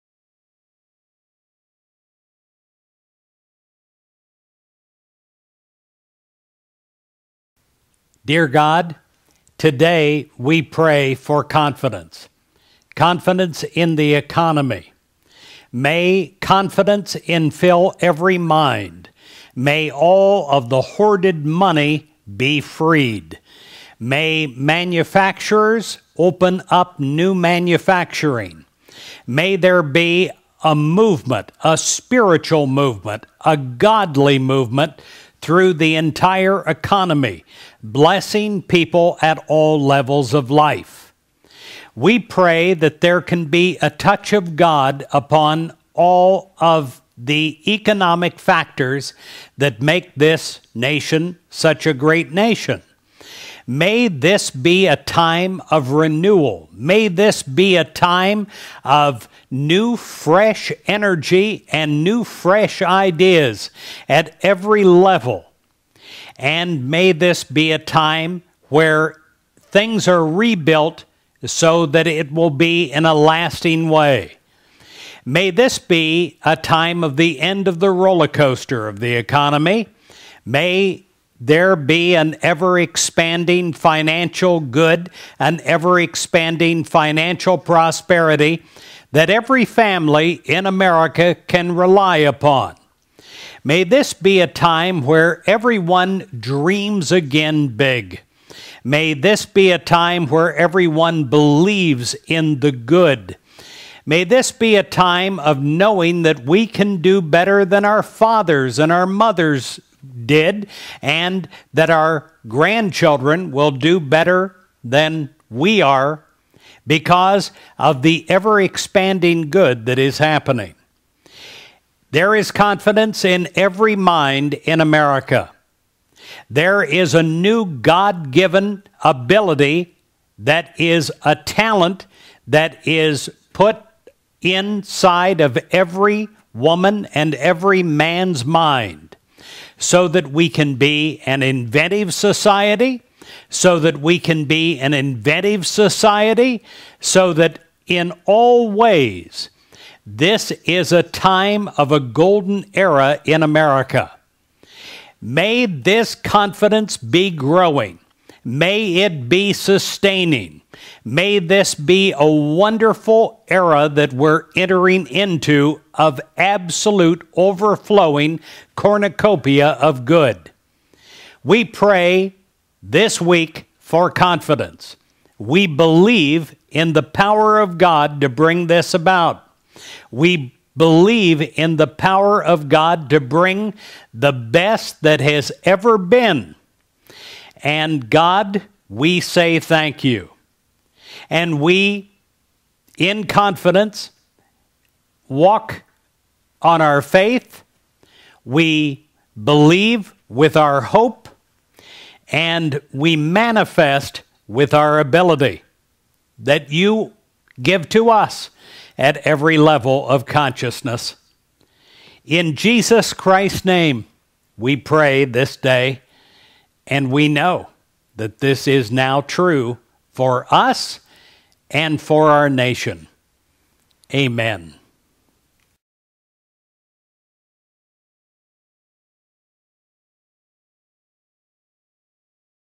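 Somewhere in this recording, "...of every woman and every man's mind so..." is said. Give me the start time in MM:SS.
02:15.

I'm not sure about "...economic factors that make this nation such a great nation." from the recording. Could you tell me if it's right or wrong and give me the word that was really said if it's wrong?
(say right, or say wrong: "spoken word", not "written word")
right.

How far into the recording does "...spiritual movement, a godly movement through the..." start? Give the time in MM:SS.
00:31.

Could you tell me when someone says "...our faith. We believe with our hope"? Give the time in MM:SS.
03:16.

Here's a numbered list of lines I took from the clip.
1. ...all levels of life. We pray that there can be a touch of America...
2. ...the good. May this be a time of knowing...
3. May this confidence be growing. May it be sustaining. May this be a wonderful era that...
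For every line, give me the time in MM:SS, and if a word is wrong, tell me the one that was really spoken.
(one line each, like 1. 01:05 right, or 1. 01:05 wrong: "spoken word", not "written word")
1. 00:39 wrong: "God", not "America"
2. 01:42 right
3. 02:35 right.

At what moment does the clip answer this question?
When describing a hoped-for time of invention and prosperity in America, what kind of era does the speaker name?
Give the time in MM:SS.
02:31.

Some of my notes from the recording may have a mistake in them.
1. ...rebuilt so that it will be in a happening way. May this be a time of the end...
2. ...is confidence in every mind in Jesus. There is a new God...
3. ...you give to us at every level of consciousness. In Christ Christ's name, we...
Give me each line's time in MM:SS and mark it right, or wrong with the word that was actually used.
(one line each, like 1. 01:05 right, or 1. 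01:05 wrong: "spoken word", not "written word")
1. 01:10 wrong: "lasting", not "happening"
2. 02:02 wrong: "America", not "Jesus"
3. 03:26 wrong: "Jesus", not "Christ".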